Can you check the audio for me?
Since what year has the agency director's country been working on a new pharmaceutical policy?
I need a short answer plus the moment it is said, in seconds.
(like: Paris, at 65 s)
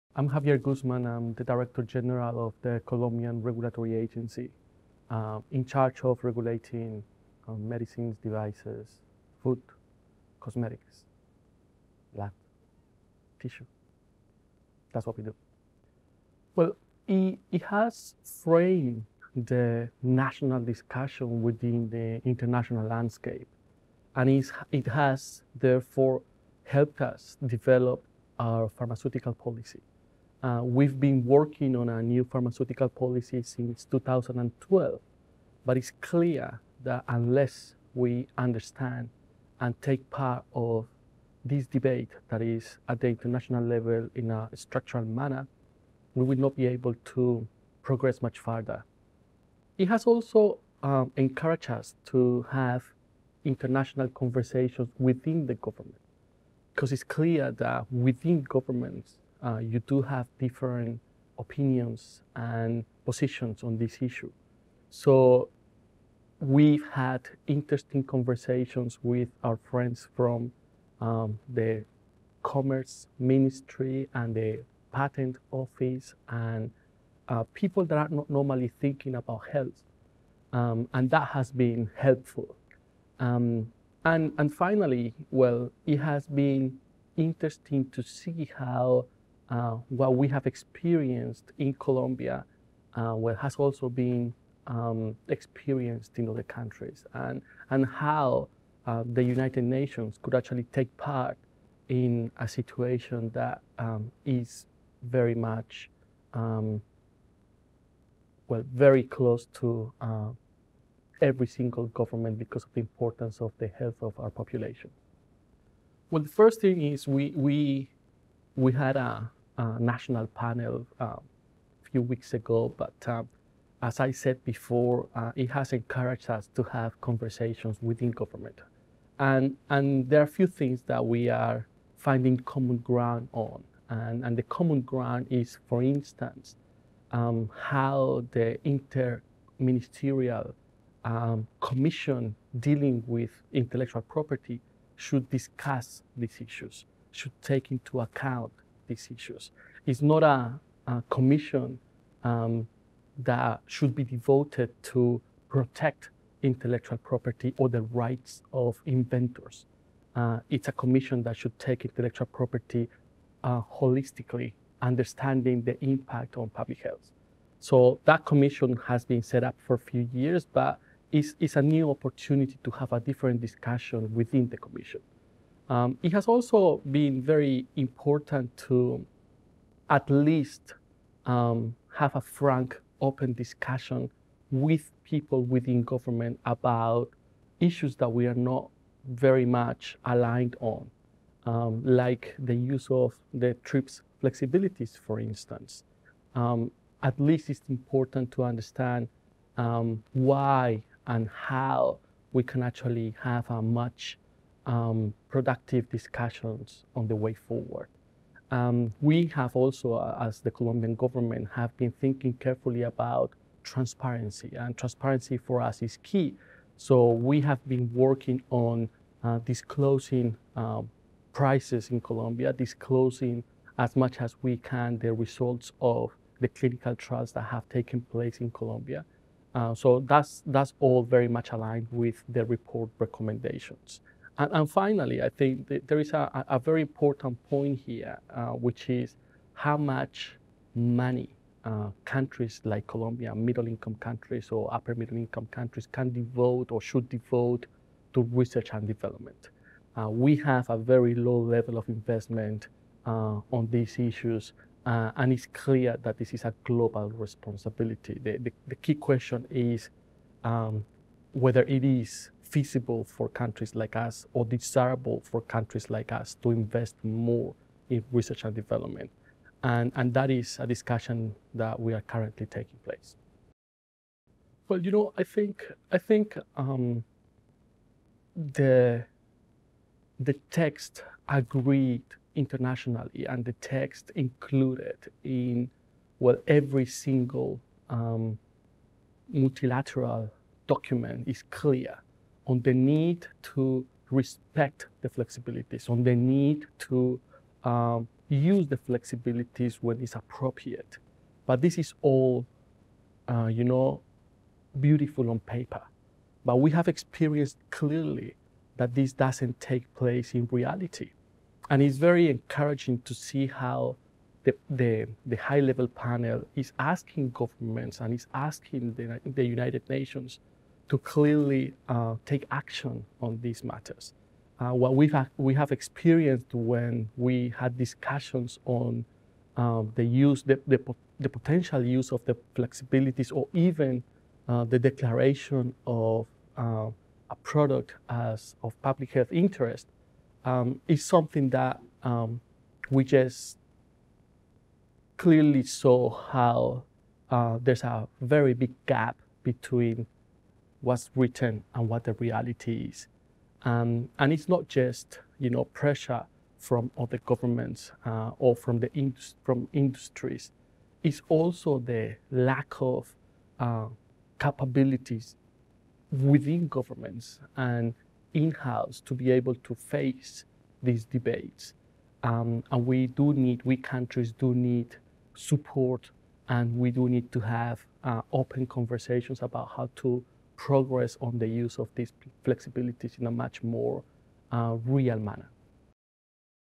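2012, at 33 s.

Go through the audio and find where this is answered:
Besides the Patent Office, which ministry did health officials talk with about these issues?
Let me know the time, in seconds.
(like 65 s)
72 s.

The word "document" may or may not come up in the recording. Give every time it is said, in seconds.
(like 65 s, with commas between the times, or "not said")
290 s.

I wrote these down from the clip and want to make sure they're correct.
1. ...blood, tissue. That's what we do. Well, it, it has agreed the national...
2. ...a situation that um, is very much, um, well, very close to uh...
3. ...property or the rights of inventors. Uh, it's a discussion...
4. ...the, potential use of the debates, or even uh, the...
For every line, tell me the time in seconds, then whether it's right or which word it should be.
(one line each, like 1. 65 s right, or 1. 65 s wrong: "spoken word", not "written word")
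1. 12 s wrong: "framed", not "agreed"
2. 102 s right
3. 157 s wrong: "commission", not "discussion"
4. 331 s wrong: "flexibilities", not "debates".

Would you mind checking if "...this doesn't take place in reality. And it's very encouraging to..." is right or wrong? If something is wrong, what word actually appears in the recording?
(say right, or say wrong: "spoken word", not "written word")
right.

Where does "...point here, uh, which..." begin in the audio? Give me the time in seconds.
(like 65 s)
237 s.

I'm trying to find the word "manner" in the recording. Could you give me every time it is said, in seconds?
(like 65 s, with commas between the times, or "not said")
45 s, 385 s.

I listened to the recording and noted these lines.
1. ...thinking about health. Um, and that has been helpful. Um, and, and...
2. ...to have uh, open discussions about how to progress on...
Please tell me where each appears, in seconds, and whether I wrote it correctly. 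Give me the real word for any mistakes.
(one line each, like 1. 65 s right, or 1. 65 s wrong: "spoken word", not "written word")
1. 78 s right
2. 377 s wrong: "conversations", not "discussions".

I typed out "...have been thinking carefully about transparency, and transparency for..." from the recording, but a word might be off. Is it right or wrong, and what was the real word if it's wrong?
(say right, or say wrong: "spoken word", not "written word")
right.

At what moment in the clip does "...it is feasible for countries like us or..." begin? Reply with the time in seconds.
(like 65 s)
261 s.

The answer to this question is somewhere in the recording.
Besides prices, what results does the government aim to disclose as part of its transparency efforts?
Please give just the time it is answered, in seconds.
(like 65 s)
226 s.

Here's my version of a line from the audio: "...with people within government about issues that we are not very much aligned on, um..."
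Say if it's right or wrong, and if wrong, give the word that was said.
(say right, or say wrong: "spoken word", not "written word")
right.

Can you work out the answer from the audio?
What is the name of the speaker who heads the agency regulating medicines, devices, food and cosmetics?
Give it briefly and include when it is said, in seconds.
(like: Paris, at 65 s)
Javier Guzmán, at 0 s.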